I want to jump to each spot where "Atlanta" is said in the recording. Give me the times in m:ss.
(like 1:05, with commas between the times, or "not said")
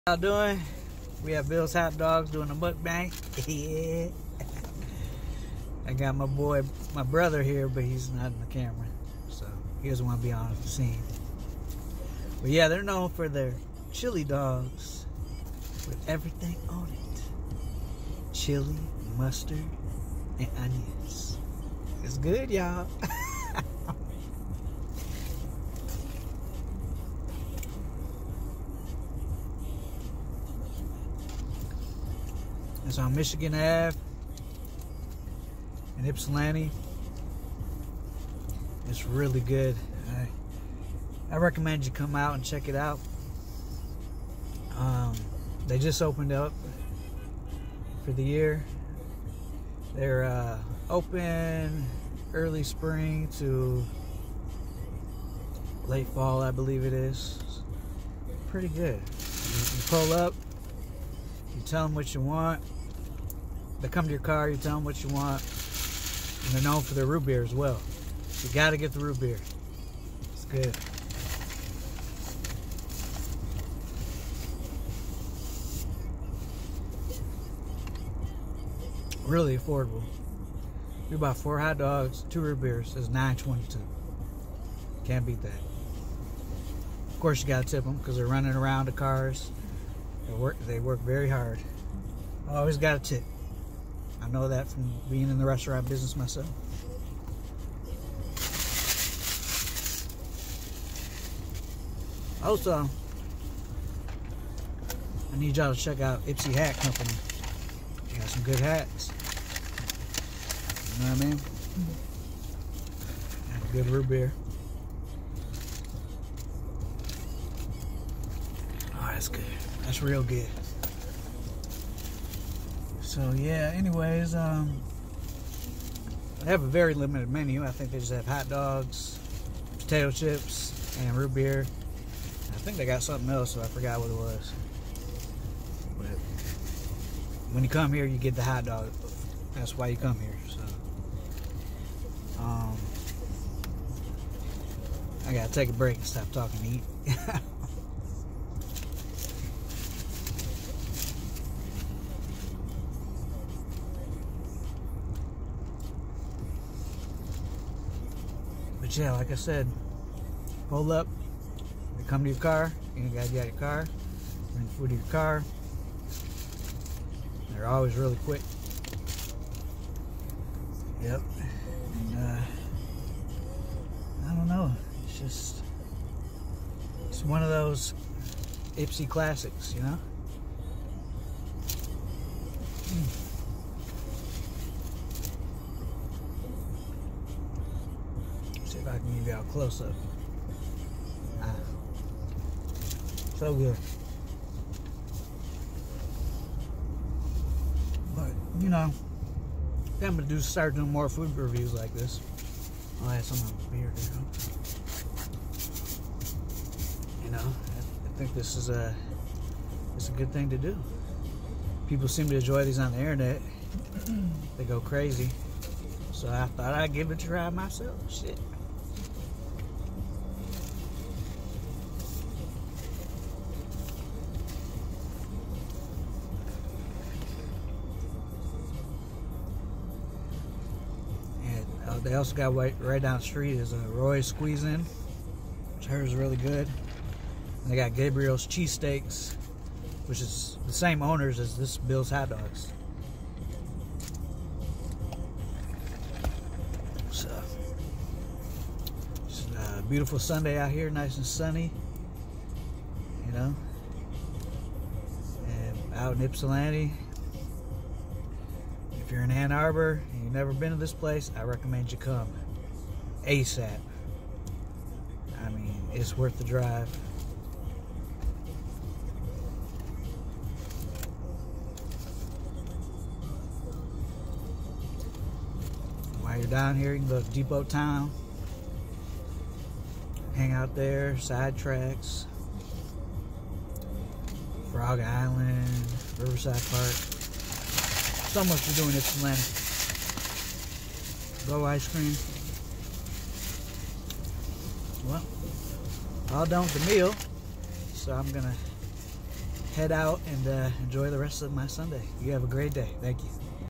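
4:49.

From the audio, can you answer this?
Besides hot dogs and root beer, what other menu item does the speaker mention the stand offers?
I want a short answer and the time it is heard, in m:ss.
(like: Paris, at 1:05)
Potato chips, at 2:09.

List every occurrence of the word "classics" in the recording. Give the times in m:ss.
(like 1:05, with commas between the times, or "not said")
2:59.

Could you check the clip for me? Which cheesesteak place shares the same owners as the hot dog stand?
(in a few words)
Gabriel's Cheesesteaks.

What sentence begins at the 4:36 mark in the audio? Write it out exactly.
While you're down here, you can go to Depot Town.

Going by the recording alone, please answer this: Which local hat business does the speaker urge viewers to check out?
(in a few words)
Ypsi Hat Company.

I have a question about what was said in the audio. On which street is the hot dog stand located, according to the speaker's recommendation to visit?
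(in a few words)
Michigan Ave.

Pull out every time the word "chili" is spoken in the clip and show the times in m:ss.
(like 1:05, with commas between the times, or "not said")
0:13, 0:18.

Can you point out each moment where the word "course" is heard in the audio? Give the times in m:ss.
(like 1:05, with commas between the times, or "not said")
1:27.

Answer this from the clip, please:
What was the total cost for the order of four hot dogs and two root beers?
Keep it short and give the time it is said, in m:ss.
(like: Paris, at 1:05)
$9.22, at 1:23.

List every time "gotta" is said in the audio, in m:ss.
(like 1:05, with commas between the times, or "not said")
1:08, 1:27, 1:32, 2:25, 2:43.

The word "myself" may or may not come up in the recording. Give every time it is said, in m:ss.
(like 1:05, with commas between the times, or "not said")
1:36, 3:37.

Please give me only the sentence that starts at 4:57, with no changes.
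So I'm going to head out and uh, enjoy the rest of my Sunday.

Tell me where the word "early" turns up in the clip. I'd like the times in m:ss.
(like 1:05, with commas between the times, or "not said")
0:52.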